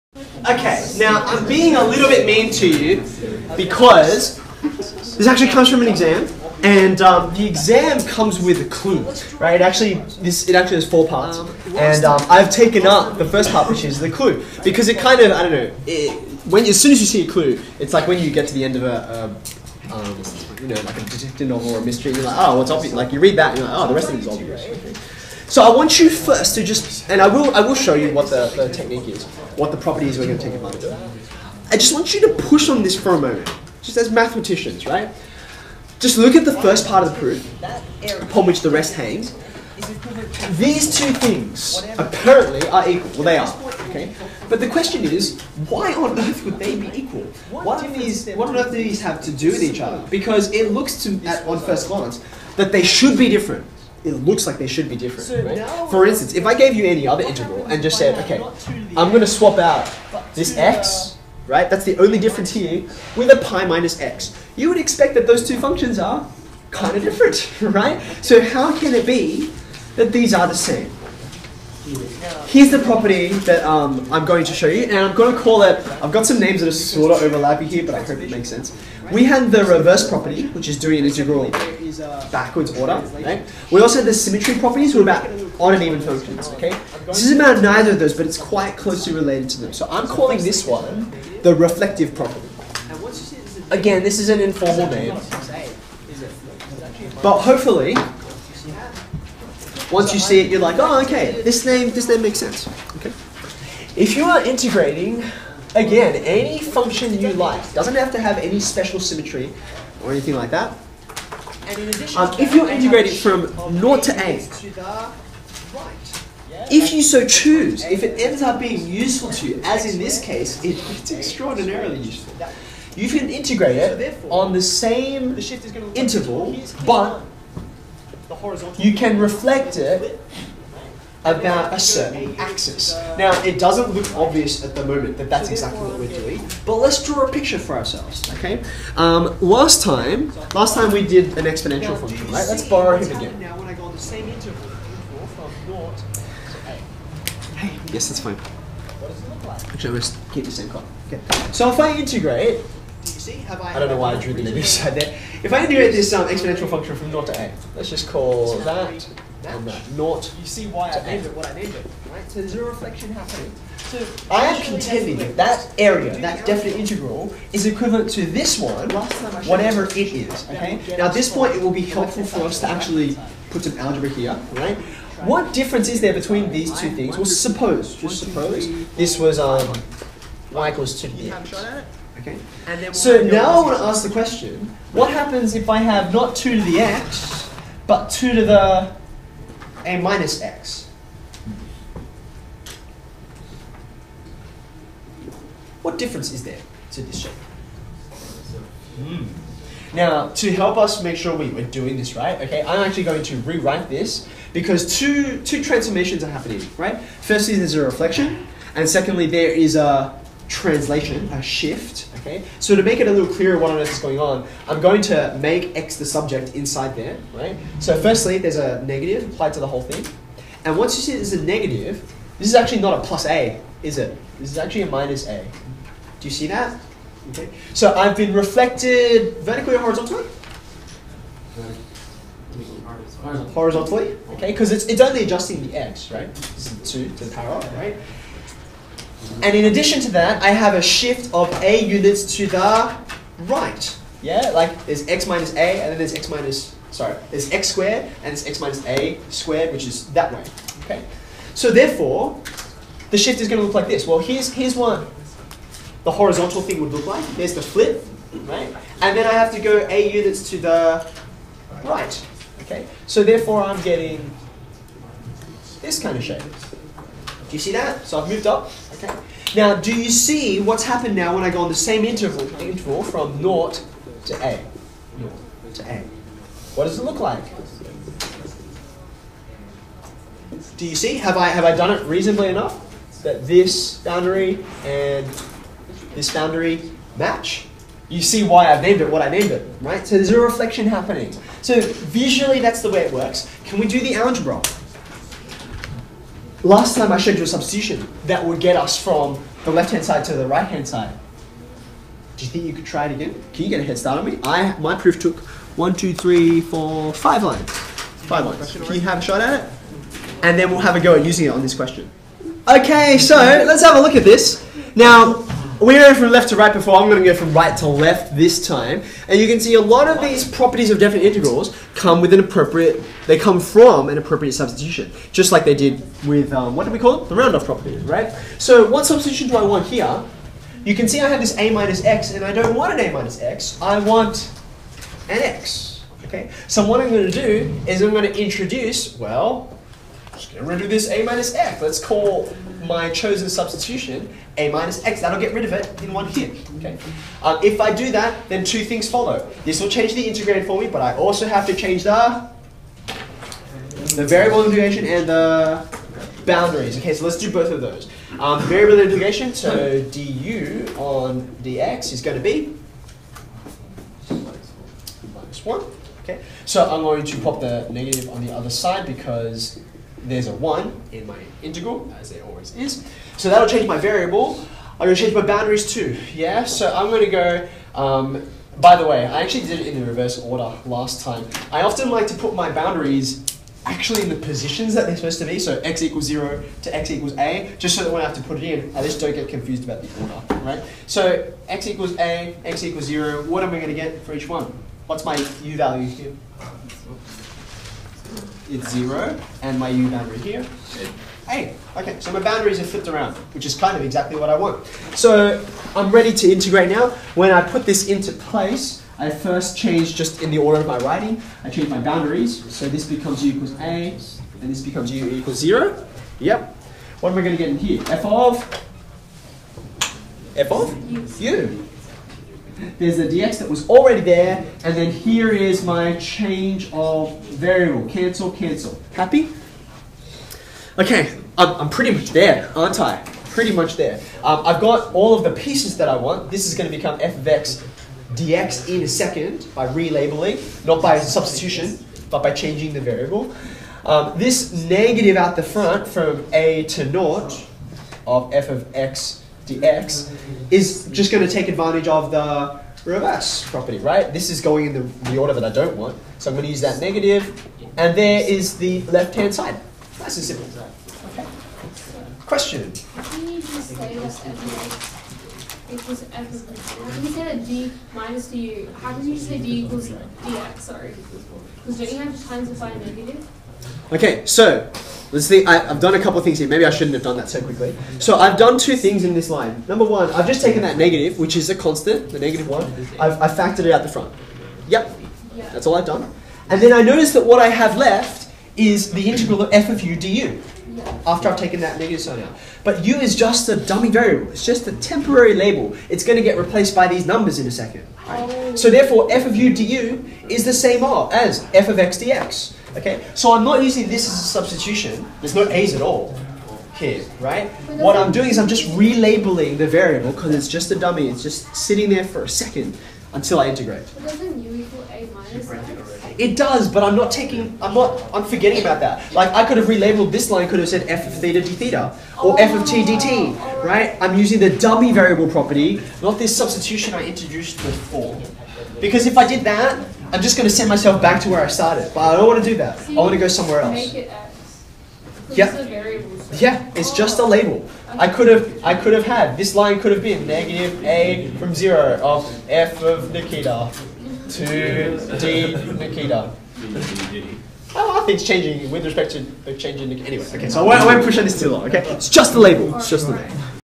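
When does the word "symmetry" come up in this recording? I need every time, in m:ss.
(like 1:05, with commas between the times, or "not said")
1:24, 1:48.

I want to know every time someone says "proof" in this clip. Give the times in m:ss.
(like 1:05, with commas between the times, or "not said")
0:37, 5:04.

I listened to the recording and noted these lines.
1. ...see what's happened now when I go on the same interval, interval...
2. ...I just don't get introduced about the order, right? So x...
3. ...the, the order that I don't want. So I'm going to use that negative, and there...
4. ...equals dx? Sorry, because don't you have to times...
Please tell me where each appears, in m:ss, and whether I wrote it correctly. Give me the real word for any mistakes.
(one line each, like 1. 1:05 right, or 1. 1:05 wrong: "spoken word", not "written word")
1. 4:30 right
2. 6:28 wrong: "confused", not "introduced"
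3. 7:34 right
4. 7:49 right.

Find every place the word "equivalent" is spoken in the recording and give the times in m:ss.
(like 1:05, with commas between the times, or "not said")
2:47.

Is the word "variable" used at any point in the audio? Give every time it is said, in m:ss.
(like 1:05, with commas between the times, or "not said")
5:54, 5:58, 6:13, 7:07, 7:23, 8:14, 8:29, 8:45.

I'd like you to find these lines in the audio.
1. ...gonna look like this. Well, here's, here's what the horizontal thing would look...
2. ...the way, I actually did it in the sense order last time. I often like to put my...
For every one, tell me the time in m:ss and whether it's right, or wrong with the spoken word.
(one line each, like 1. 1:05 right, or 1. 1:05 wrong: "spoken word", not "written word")
1. 4:13 right
2. 6:18 wrong: "reverse", not "sense".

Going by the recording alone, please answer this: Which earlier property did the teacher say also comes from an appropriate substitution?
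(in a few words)
round off property.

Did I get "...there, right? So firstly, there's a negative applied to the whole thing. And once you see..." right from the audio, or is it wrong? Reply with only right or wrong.
right.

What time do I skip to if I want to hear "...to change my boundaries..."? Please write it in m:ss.
6:15.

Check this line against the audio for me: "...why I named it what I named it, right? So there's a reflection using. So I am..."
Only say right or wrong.
wrong.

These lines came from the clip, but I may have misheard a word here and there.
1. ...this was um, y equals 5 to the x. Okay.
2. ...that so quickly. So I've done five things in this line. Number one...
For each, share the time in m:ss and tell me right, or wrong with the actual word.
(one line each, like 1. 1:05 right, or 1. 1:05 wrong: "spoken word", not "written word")
1. 2:58 wrong: "2", not "5"
2. 7:57 wrong: "two", not "five".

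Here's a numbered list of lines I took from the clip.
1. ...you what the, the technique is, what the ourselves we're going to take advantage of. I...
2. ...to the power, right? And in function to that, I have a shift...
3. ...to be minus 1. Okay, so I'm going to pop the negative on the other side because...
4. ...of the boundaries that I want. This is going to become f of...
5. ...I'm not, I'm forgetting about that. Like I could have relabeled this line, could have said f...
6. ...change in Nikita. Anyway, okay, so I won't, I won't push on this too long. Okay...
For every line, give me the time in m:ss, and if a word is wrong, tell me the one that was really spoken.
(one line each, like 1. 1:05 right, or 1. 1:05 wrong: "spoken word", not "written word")
1. 0:27 wrong: "properties", not "ourselves"
2. 3:57 wrong: "addition", not "function"
3. 6:02 right
4. 7:15 wrong: "pieces", not "boundaries"
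5. 8:37 right
6. 9:09 right.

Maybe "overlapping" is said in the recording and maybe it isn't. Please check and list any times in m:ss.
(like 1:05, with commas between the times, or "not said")
1:17.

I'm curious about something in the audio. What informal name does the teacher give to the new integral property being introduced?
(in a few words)
reflective property.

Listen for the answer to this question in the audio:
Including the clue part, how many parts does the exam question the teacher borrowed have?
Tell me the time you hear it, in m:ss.
0:10.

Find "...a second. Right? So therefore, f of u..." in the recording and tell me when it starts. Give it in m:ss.
8:17.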